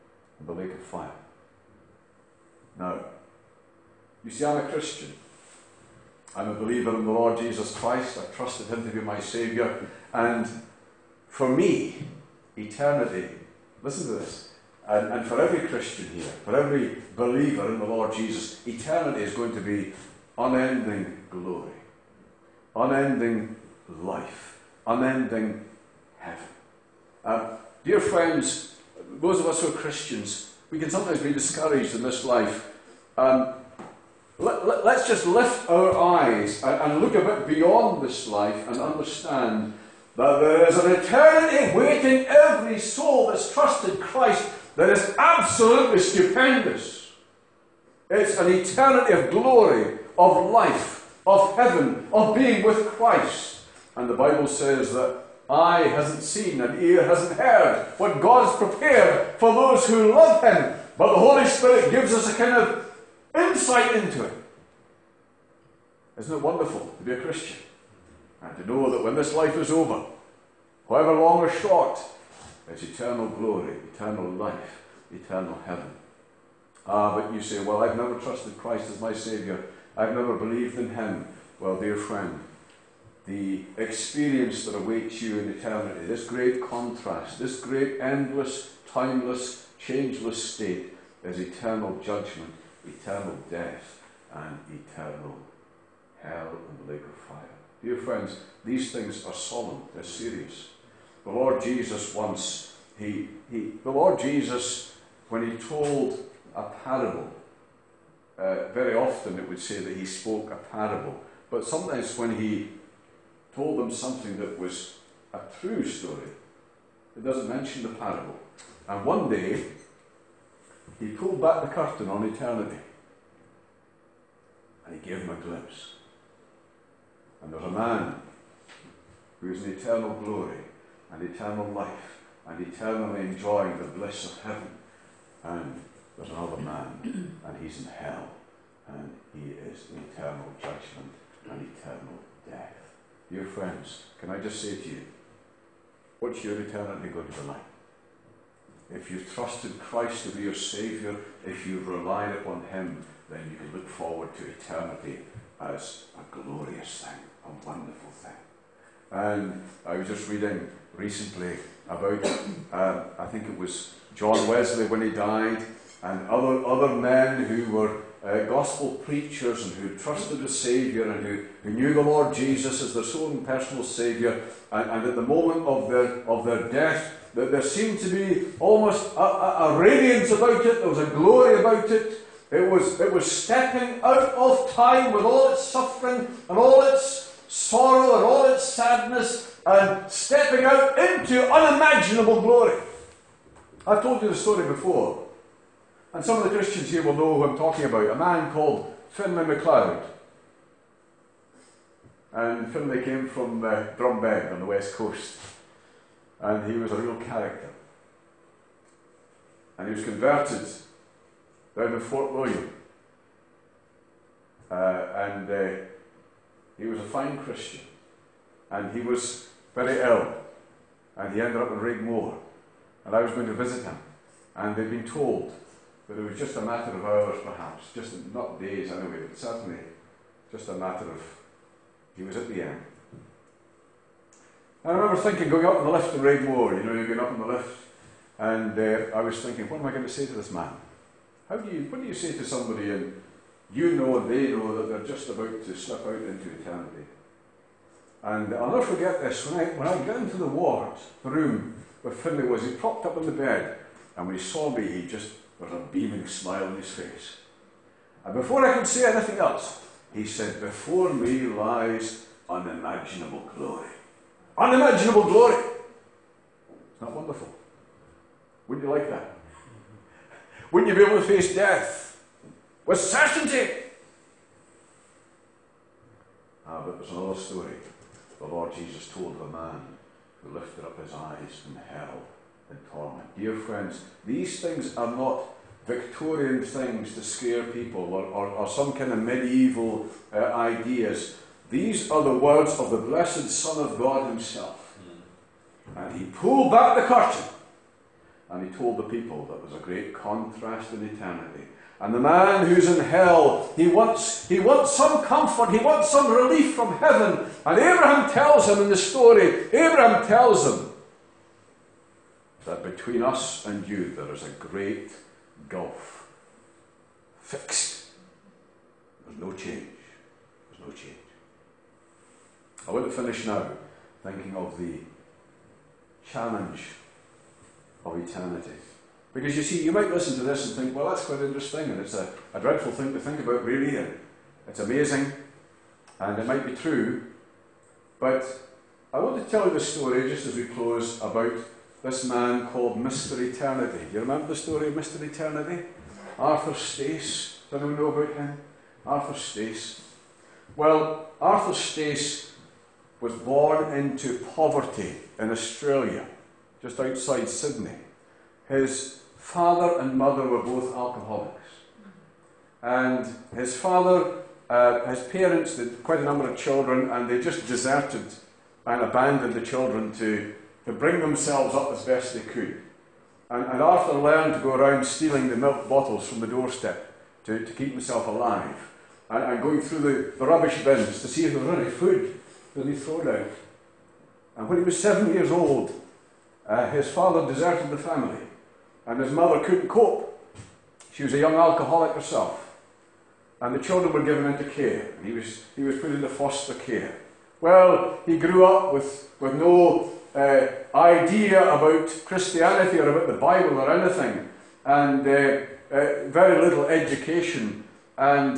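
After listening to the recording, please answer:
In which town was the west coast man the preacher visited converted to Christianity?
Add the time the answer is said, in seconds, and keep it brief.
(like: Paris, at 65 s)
Fort William, at 211 s.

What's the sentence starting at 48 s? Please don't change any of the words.
It's an eternity of glory, of life, of heaven, of being with Christ.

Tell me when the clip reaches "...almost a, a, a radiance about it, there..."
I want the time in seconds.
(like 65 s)
178 s.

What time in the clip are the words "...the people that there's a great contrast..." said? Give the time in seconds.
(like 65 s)
298 s.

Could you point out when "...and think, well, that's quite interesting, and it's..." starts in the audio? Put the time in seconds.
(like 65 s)
330 s.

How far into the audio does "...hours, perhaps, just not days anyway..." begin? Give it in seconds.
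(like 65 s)
227 s.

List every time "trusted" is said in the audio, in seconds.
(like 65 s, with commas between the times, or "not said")
8 s, 43 s, 78 s, 149 s, 169 s.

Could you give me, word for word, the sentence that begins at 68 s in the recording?
and to know that when this life is over, however long or short, there's eternal glory, eternal life, eternal heaven.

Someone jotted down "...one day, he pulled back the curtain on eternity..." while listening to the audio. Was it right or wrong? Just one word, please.
right.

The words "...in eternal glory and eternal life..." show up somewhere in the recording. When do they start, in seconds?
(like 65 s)
129 s.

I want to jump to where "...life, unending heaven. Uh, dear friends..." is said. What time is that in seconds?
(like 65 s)
24 s.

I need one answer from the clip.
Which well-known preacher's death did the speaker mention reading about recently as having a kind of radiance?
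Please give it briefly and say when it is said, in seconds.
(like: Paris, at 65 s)
John Wesley, at 164 s.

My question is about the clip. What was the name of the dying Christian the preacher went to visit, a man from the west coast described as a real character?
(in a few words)
Finlay MacLeod.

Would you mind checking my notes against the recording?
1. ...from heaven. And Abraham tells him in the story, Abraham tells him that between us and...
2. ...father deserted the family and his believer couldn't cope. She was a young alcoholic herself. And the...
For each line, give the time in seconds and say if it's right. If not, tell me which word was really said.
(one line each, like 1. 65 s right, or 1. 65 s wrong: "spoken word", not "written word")
1. 306 s right
2. 387 s wrong: "mother", not "believer".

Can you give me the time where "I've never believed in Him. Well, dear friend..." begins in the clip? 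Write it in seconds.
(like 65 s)
79 s.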